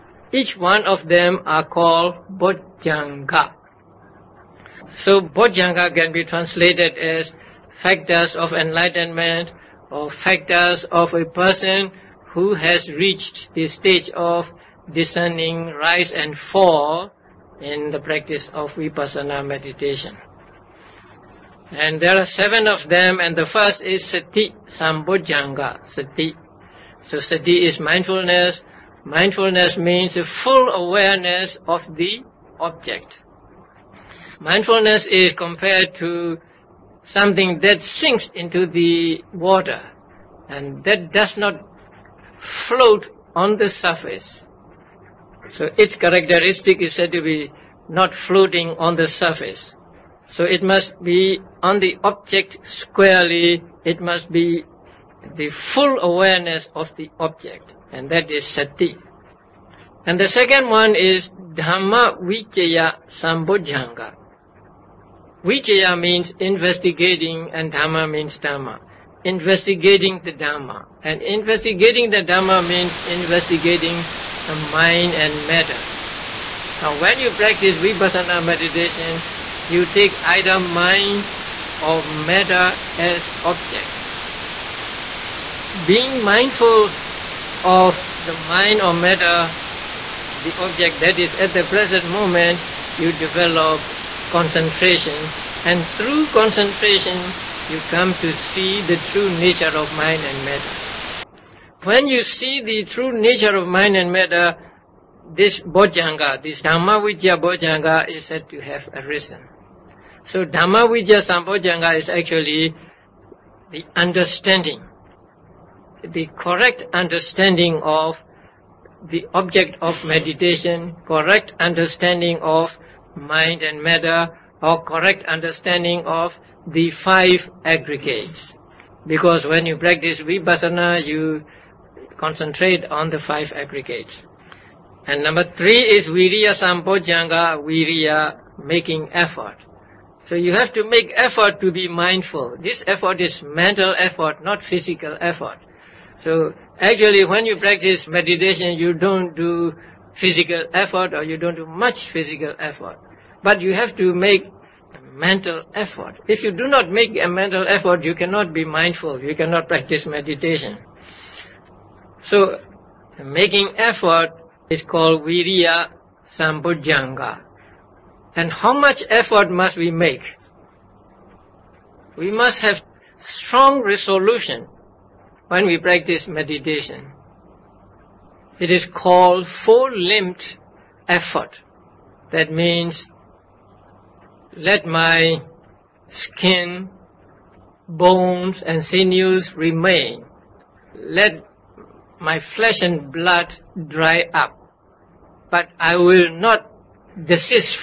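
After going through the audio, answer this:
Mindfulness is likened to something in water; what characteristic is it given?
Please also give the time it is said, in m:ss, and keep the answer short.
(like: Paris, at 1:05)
Not floating on the surface, at 0:47.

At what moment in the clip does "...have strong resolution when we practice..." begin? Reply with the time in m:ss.
2:52.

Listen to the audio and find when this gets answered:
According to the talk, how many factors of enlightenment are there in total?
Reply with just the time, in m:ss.
0:22.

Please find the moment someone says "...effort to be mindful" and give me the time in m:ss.
2:21.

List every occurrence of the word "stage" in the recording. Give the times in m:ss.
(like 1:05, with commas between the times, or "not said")
0:13.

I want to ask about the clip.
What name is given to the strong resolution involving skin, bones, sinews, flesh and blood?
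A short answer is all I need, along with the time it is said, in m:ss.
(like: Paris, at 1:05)
Four-limbed effort, at 2:59.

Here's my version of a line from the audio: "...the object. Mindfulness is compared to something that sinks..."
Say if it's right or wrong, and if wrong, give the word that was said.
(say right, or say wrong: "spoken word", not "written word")
right.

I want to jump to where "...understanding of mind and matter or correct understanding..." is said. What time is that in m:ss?
2:01.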